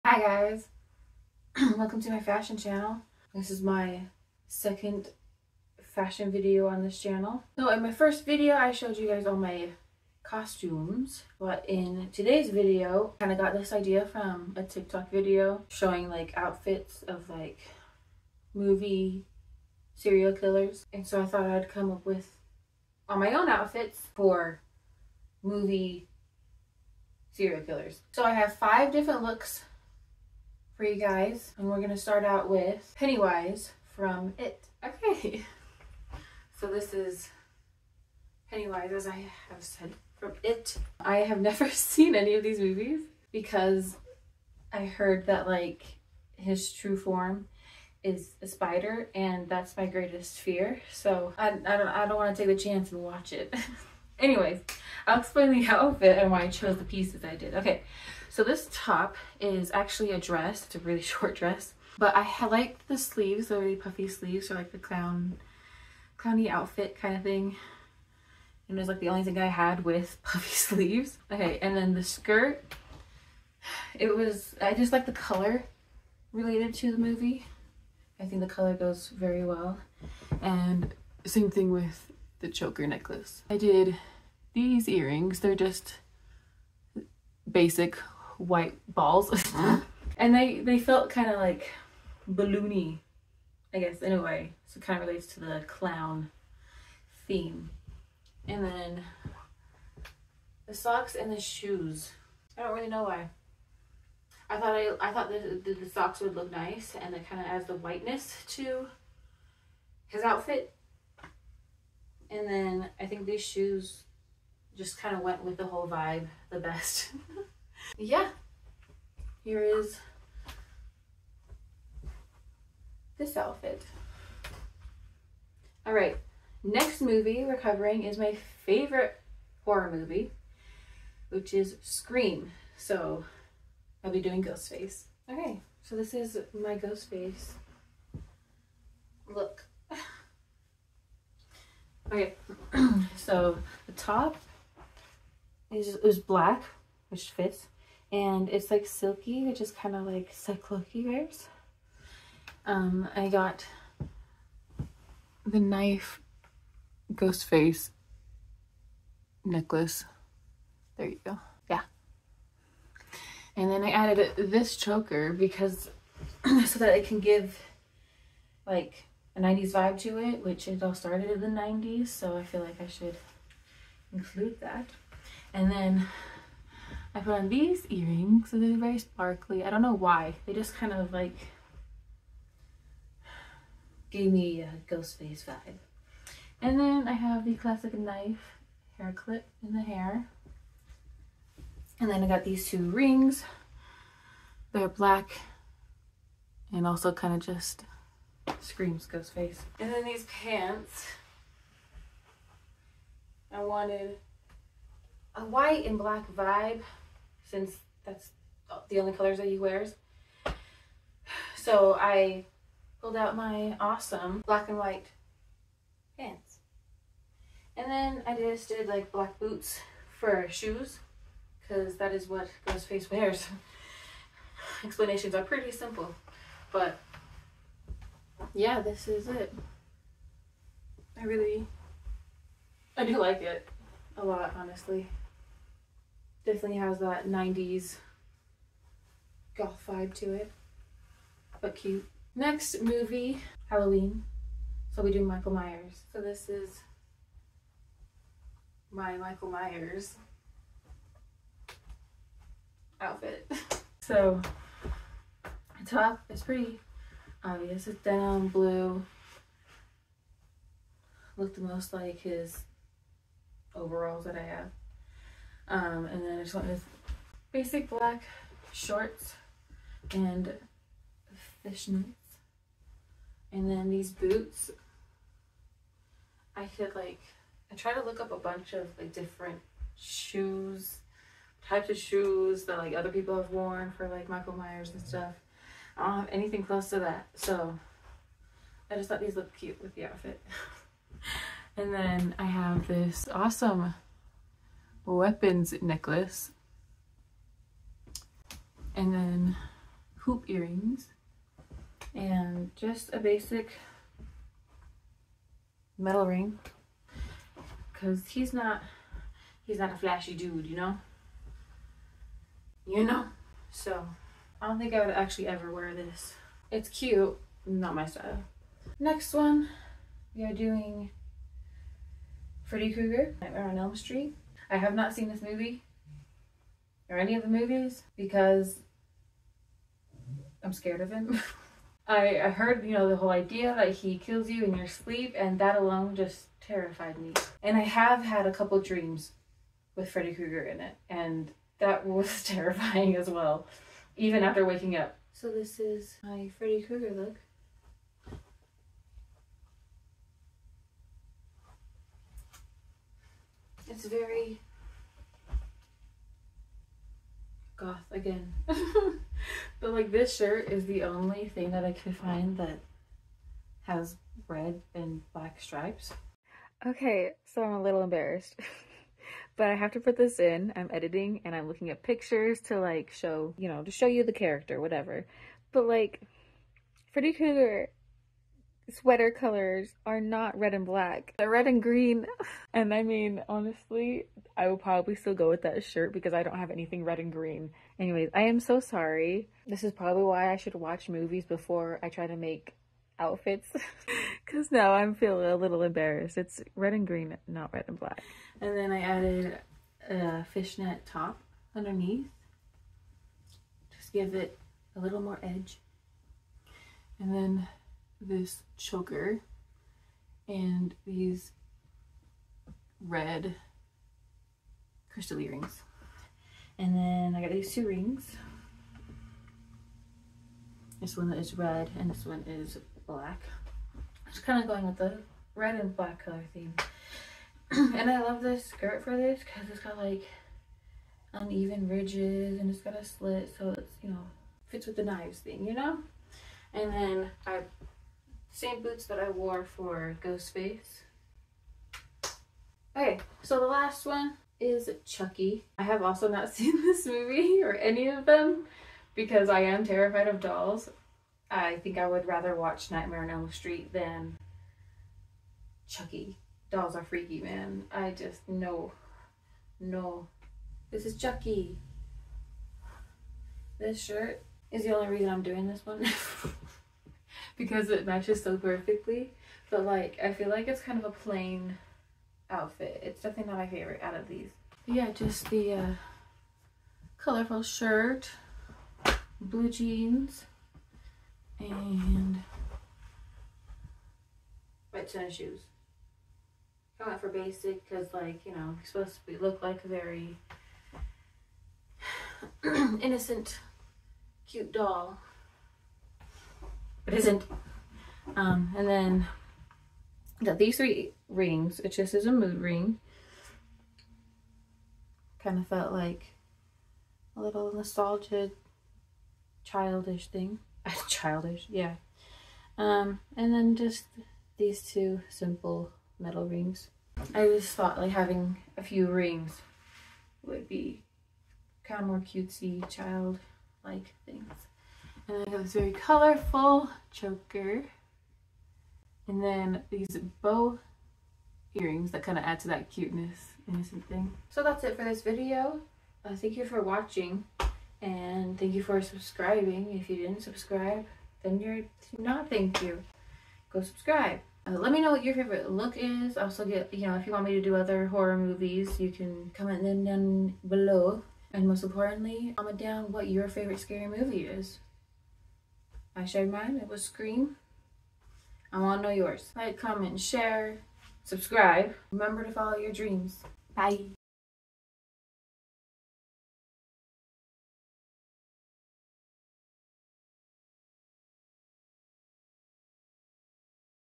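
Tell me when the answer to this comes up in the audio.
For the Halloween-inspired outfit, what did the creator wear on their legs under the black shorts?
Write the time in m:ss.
4:31.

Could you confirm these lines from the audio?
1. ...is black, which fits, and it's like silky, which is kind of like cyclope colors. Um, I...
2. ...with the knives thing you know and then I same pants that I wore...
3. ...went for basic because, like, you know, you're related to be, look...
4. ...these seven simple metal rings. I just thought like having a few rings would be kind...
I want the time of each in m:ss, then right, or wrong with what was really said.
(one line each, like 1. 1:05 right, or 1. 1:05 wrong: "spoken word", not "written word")
1. 2:25 wrong: "wears", not "colors"
2. 7:14 wrong: "boots", not "pants"
3. 8:07 wrong: "supposed", not "related"
4. 8:34 wrong: "two", not "seven".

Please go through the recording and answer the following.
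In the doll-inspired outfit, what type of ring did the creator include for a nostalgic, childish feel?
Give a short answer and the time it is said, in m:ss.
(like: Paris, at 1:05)
Mood ring, at 8:22.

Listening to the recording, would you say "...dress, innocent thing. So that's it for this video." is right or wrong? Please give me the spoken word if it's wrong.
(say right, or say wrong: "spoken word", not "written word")
wrong: "cuteness", not "dress".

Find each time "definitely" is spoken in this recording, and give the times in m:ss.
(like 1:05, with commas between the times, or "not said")
3:56, 7:53.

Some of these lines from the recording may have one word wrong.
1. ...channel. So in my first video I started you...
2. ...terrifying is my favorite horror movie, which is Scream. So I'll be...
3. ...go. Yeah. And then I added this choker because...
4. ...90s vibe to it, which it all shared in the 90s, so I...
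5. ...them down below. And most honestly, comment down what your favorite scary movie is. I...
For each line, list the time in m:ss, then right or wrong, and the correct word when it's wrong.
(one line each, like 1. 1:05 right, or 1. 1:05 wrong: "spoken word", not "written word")
1. 0:07 wrong: "showed", not "started"
2. 2:07 wrong: "covering", not "terrifying"
3. 2:41 right
4. 2:49 wrong: "started", not "shared"
5. 9:09 wrong: "importantly", not "honestly".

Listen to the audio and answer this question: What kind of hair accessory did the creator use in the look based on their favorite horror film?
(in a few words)
Knife hair clip.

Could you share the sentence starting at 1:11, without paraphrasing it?
Okay, and then the skirt, it was, I just like the color related to the movie.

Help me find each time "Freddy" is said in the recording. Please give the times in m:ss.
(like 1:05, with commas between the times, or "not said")
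5:22, 5:40, 5:46, 6:17.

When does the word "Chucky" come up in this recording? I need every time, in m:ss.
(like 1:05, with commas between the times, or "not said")
7:25, 7:35, 7:41.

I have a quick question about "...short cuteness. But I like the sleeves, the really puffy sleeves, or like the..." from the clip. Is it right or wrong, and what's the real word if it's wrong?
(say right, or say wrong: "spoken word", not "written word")
wrong: "dress", not "cuteness".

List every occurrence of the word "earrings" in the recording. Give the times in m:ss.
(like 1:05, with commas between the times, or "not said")
1:24, 2:57, 5:00, 6:55, 8:51.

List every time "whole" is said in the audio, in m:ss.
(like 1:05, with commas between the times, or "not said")
1:55, 5:33.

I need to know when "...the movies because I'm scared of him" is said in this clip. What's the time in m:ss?
5:27.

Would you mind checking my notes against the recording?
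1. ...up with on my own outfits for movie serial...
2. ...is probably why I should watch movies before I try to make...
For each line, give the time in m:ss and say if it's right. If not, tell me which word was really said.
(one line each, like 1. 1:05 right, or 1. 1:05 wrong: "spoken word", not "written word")
1. 0:21 right
2. 6:29 right.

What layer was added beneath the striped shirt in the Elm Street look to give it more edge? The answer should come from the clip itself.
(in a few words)
A fishnet top.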